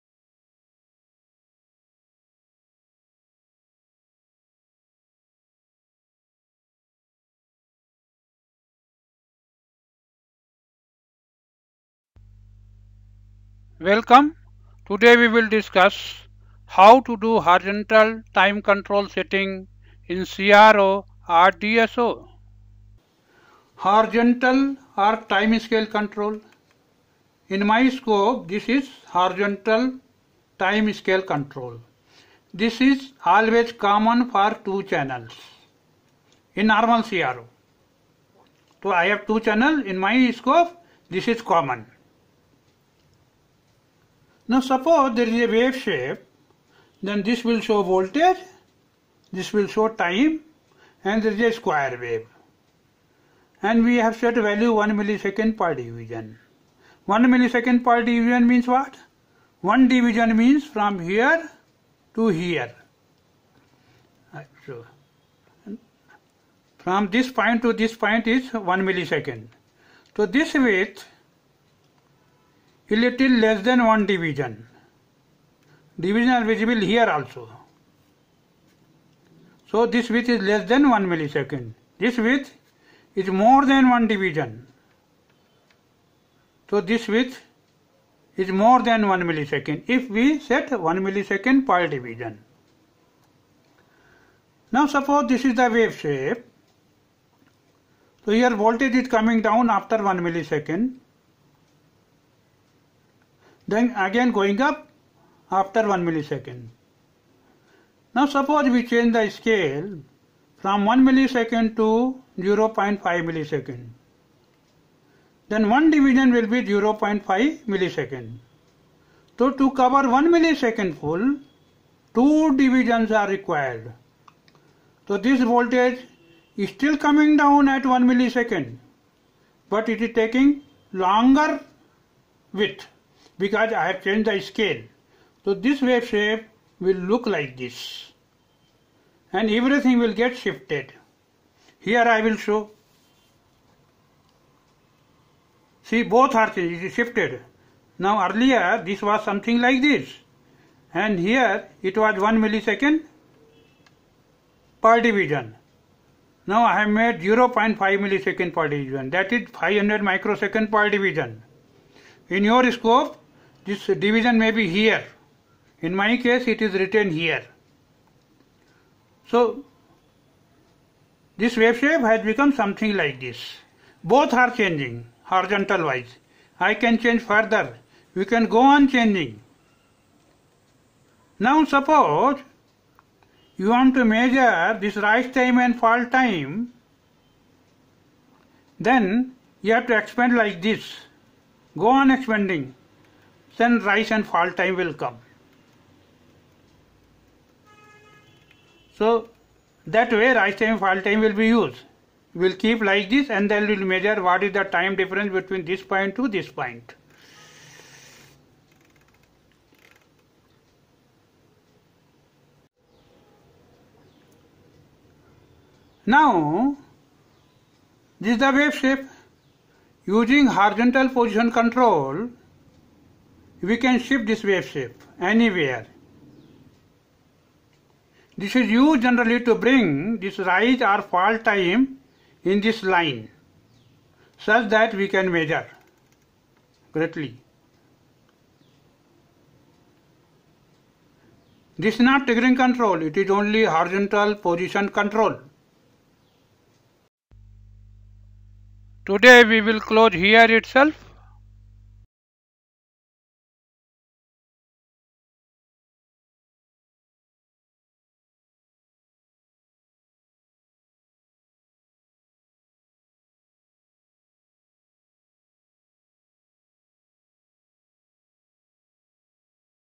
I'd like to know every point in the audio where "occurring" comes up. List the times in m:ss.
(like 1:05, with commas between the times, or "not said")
not said.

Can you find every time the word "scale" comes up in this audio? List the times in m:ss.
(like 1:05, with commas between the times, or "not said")
0:25, 0:30, 1:49, 2:14.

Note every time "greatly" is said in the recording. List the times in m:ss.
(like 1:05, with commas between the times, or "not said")
3:56.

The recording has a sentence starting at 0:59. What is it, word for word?
1 division means from here to here.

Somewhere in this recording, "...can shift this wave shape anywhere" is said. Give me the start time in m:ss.
3:43.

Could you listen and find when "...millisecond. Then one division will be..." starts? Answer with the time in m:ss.
1:53.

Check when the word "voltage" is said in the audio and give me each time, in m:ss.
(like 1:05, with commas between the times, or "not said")
0:47, 1:38, 2:05.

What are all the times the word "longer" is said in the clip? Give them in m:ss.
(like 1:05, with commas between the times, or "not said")
2:10.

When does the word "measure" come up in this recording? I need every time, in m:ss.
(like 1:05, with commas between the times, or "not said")
3:04, 3:23, 3:55.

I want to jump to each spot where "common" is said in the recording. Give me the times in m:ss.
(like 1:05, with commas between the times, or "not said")
0:33, 0:41.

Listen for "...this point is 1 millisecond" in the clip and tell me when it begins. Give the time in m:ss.
1:07.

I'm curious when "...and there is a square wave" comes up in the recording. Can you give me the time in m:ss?
0:51.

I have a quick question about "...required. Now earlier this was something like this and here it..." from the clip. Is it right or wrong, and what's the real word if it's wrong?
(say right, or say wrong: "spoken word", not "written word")
wrong: "shifted", not "required".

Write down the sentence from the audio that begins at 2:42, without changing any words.
In your scope this division may be here.